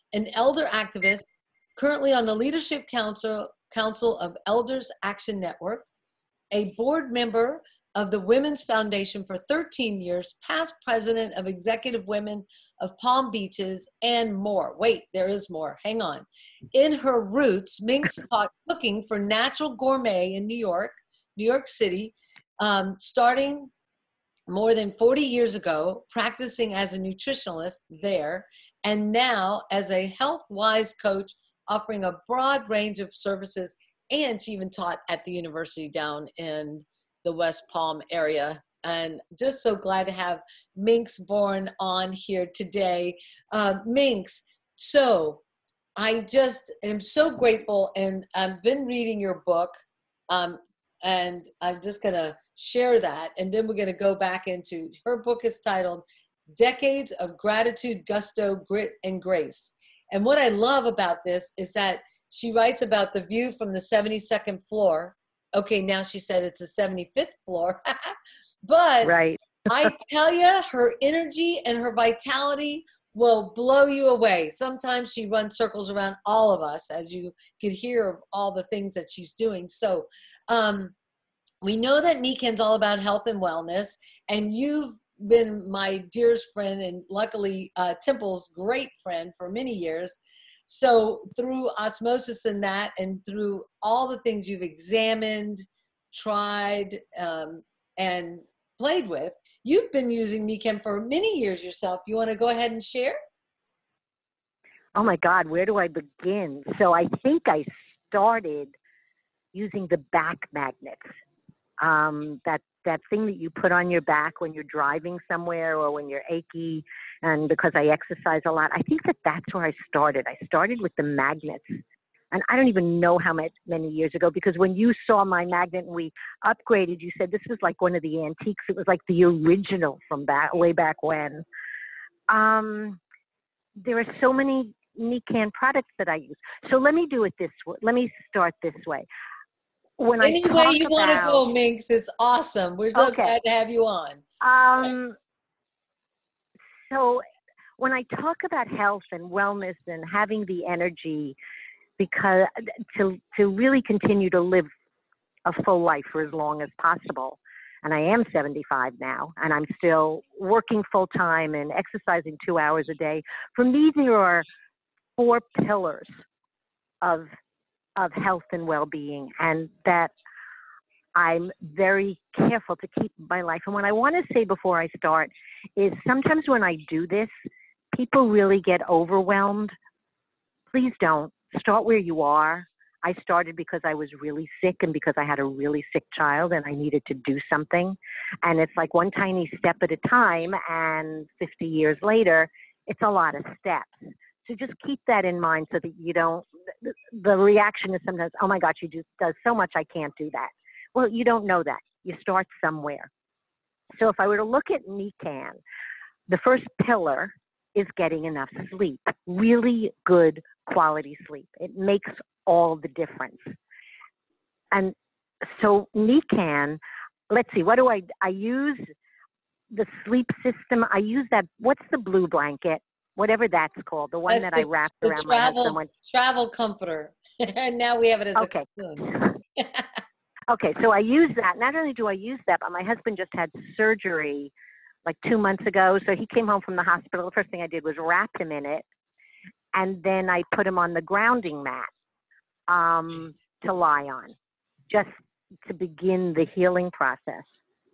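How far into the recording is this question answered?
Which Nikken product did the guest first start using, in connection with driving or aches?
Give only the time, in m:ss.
1:50.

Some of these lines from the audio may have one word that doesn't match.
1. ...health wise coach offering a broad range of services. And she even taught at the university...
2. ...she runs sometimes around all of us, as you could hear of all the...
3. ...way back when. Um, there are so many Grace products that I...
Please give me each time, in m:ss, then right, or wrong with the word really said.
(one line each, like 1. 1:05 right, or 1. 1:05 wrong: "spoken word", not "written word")
1. 0:30 right
2. 1:15 wrong: "circles", not "sometimes"
3. 2:10 wrong: "Nikken", not "Grace".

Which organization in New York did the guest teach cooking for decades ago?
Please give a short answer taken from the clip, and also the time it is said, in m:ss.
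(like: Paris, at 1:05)
Natural Gourmet, at 0:19.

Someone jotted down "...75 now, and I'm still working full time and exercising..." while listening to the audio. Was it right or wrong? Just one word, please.
right.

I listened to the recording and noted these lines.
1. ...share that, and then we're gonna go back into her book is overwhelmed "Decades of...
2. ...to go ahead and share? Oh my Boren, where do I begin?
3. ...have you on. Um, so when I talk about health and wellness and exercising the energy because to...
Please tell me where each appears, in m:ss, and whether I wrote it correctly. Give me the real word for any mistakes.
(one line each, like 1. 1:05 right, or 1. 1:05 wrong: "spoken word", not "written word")
1. 0:52 wrong: "titled", not "overwhelmed"
2. 1:42 wrong: "God", not "Boren"
3. 2:23 wrong: "having", not "exercising".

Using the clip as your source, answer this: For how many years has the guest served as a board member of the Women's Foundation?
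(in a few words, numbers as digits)
13 years.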